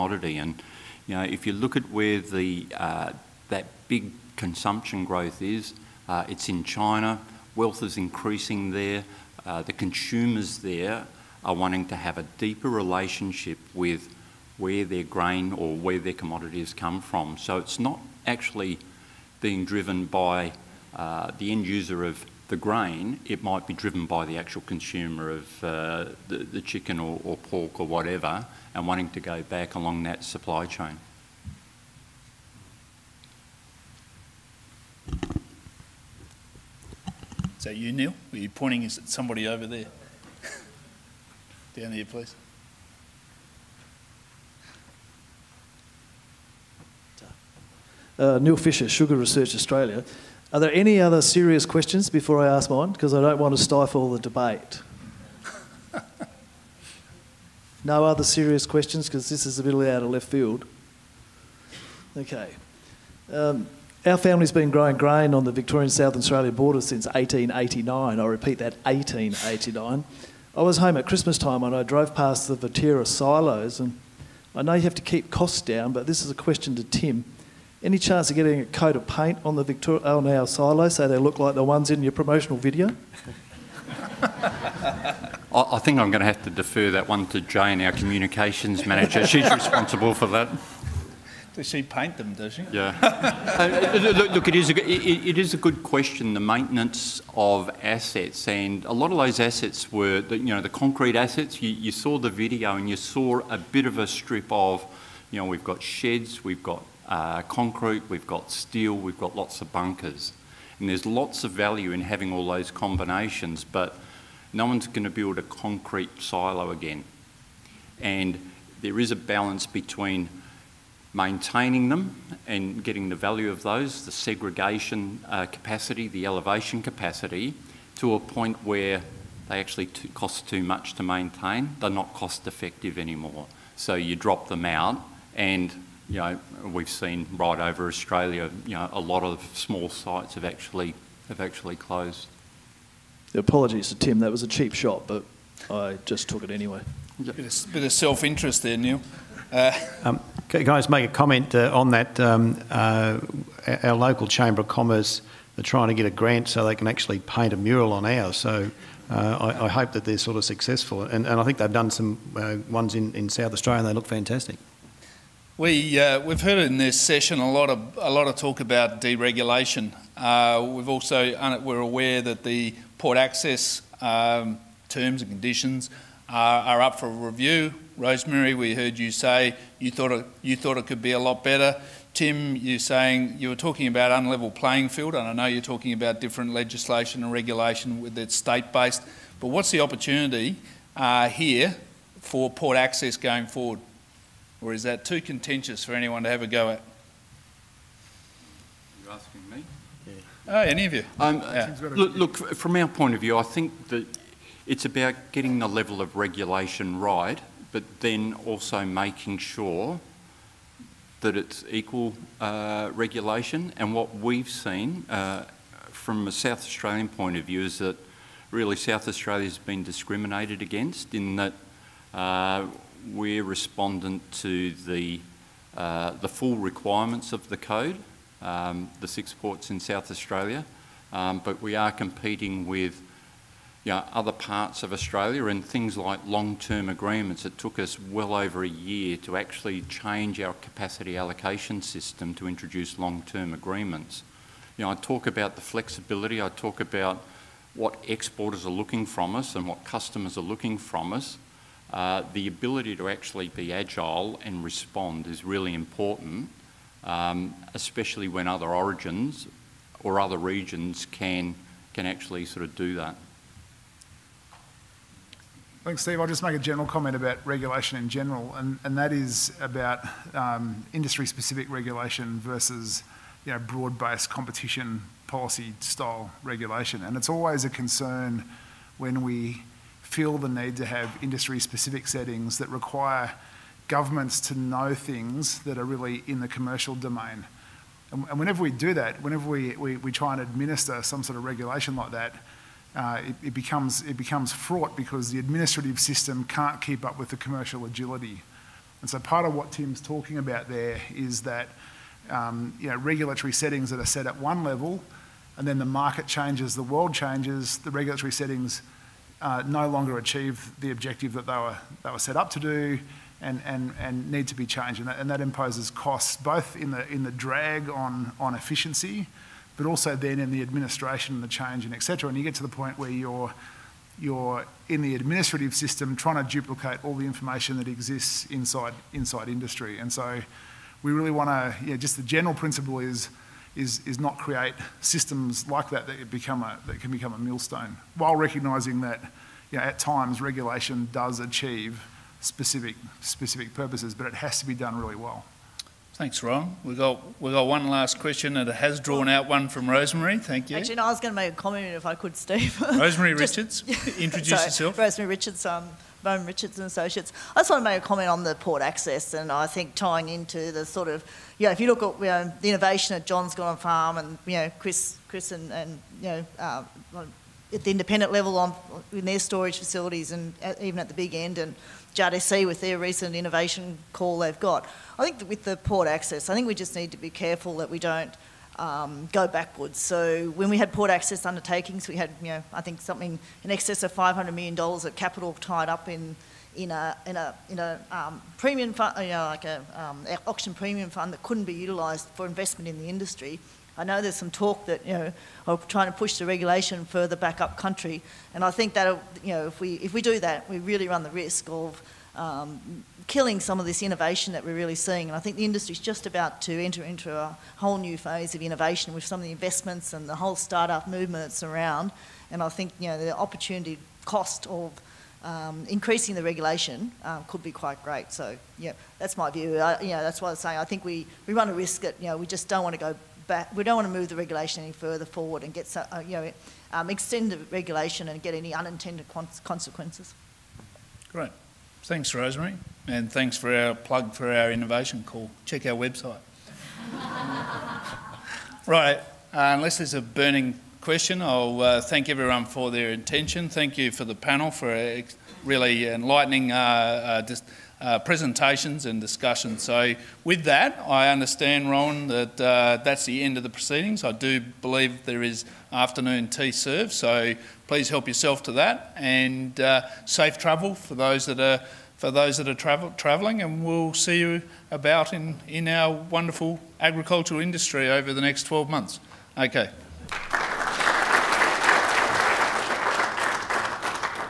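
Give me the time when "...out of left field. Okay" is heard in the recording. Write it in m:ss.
0:59.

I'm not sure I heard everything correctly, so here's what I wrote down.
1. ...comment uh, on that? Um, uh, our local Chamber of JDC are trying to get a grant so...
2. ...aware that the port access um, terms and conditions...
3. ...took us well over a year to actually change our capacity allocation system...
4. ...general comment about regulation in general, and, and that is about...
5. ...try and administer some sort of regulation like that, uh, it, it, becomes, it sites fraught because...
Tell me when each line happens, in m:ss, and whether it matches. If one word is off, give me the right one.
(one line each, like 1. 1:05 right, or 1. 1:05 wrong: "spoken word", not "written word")
1. 2:31 wrong: "Commerce", not "JDC"
2. 2:51 right
3. 3:57 right
4. 4:26 right
5. 4:50 wrong: "becomes", not "sites".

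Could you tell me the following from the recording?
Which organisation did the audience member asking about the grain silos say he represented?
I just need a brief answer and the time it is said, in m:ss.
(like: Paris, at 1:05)
Sugar Research Australia, at 0:48.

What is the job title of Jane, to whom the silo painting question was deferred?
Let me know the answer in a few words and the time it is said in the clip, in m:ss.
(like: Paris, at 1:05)
communications manager, at 1:27.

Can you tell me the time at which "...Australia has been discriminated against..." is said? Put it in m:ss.
3:39.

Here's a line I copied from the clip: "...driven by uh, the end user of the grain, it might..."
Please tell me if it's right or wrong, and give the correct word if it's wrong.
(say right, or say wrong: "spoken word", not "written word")
right.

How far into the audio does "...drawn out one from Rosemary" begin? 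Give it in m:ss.
5:48.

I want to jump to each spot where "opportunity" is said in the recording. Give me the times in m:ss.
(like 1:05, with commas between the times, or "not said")
3:09, 6:53.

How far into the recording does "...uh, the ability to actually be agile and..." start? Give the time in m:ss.
4:11.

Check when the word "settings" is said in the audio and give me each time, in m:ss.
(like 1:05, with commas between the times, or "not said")
4:42, 5:03, 5:08.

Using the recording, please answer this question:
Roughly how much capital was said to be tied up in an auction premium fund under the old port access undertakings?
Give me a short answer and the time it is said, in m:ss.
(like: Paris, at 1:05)
$500 million, at 6:24.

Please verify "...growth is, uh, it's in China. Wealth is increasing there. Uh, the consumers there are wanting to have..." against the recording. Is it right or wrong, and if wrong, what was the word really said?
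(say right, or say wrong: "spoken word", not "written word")
right.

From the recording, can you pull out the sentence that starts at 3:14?
Or is that too contentious for anyone to have a go at?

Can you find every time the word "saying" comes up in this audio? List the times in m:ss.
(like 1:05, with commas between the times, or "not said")
3:02, 7:00.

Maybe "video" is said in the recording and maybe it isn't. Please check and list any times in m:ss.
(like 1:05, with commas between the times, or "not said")
1:22, 1:42.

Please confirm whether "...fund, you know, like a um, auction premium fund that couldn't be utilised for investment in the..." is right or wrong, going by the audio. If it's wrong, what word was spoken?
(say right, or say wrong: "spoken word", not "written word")
right.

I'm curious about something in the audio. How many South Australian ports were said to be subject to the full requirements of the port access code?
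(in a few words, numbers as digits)
6.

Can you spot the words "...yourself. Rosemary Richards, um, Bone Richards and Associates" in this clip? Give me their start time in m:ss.
5:54.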